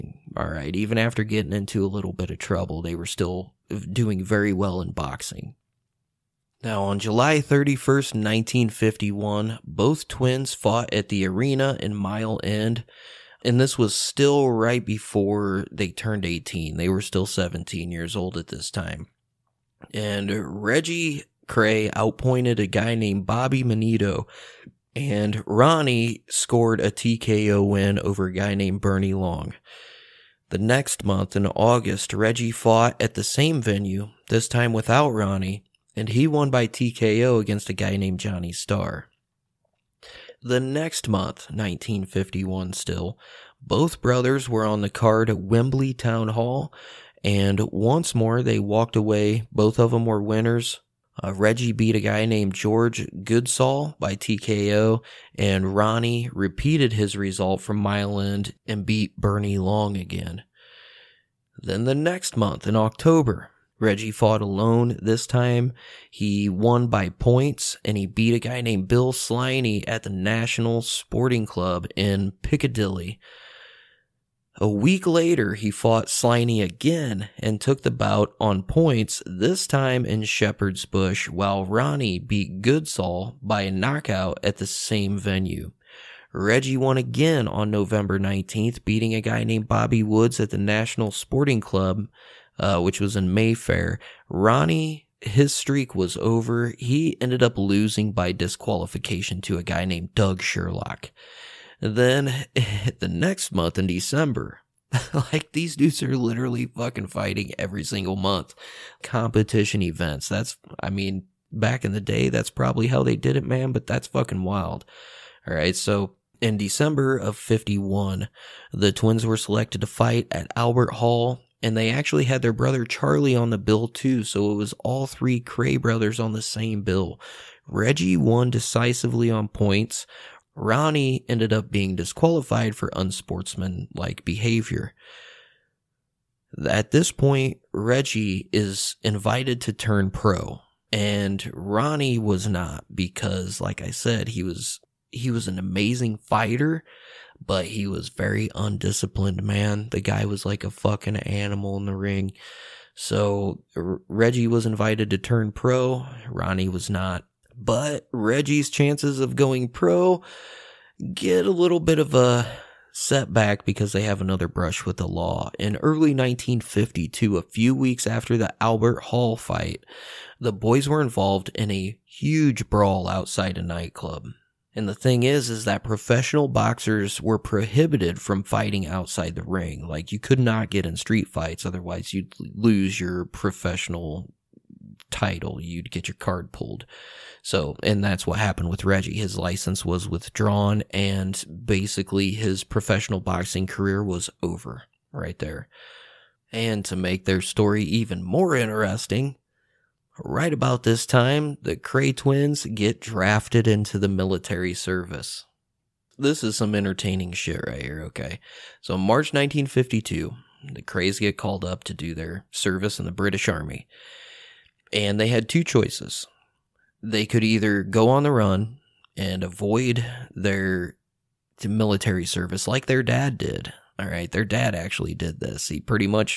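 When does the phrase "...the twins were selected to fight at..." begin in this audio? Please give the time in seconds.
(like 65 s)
118 s.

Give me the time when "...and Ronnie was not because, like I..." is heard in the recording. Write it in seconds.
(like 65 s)
140 s.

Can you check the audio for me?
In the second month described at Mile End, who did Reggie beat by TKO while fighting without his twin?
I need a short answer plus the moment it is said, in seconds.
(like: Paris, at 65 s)
Johnny Starr, at 38 s.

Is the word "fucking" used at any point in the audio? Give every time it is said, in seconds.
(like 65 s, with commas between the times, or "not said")
106 s, 114 s, 150 s.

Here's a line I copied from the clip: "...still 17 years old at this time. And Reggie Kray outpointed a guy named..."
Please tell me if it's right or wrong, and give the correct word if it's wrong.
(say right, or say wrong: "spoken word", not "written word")
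right.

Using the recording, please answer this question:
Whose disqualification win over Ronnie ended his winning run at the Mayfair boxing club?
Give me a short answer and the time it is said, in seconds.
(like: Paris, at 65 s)
Doug Sherlock, at 100 s.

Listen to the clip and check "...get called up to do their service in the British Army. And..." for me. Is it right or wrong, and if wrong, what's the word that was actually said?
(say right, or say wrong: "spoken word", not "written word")
right.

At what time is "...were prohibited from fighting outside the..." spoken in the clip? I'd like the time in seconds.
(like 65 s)
177 s.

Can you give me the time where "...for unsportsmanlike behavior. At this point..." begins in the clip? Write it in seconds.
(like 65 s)
132 s.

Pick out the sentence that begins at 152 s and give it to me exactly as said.
So R- Reggie was invited to turn pro, Ronnie was not.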